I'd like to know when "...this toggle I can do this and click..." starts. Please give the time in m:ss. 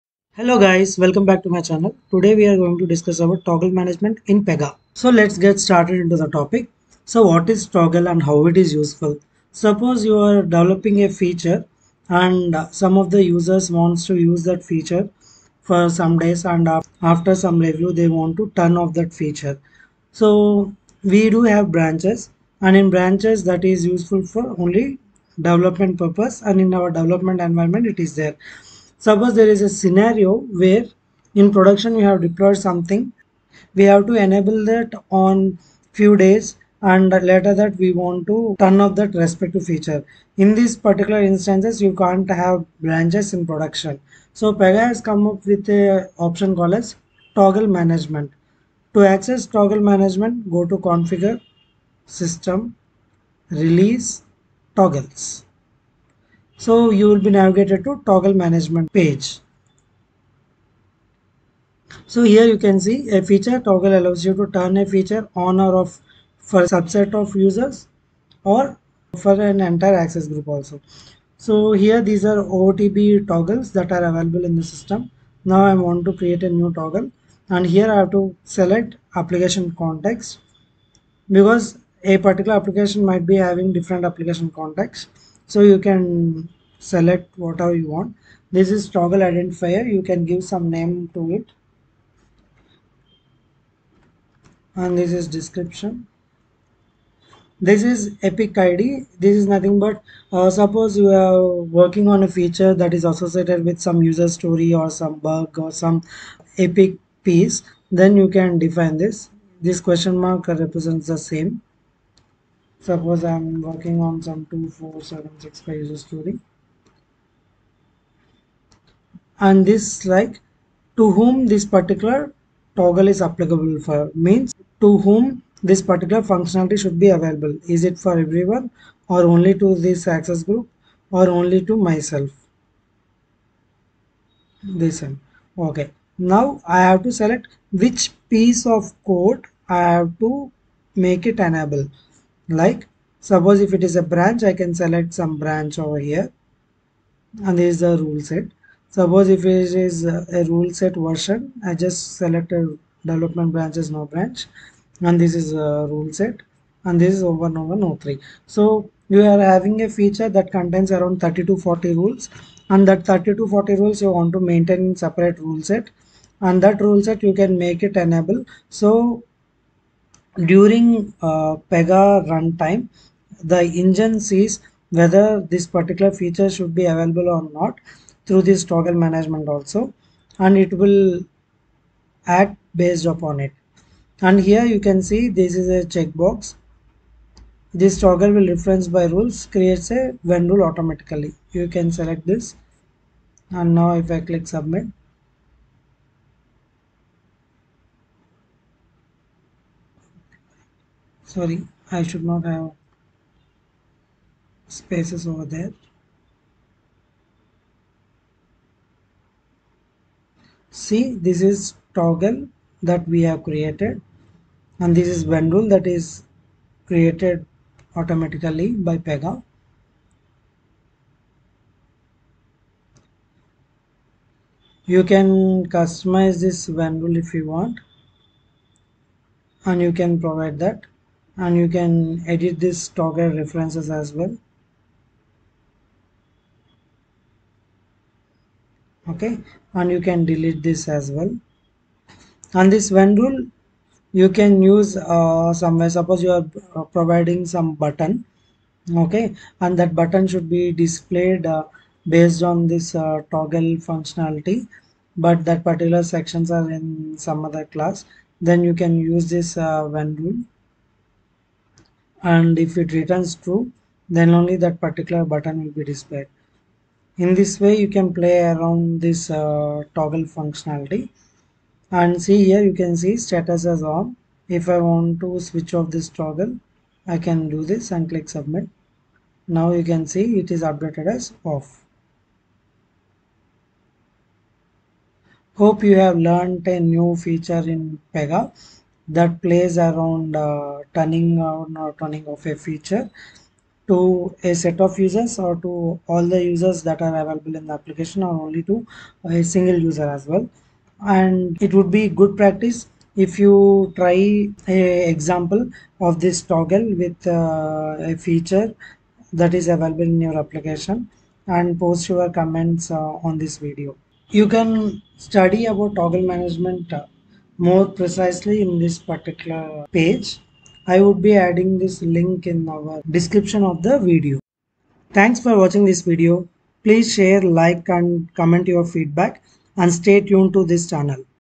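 4:35.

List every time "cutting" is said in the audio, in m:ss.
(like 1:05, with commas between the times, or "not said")
not said.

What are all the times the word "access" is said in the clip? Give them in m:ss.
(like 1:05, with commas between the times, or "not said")
0:49, 1:09, 2:10.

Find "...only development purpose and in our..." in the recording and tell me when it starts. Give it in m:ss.
0:24.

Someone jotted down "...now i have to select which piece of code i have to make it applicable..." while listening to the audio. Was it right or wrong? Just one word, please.
wrong.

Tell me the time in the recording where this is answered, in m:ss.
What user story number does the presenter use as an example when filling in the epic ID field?
1:54.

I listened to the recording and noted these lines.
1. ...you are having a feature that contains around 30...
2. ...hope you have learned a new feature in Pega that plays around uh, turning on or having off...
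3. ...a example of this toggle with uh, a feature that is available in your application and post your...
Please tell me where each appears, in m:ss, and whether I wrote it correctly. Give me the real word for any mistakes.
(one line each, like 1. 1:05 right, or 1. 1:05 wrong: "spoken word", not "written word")
1. 2:39 right
2. 4:45 wrong: "turning", not "having"
3. 5:04 right.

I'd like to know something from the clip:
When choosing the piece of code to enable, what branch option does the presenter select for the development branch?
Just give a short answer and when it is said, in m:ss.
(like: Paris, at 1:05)
No branch, at 2:33.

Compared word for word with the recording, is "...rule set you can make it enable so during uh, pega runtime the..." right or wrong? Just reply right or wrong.
right.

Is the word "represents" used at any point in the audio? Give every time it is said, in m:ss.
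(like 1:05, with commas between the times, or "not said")
1:50.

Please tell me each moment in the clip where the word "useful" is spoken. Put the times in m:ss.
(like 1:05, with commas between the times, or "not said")
0:08, 0:23.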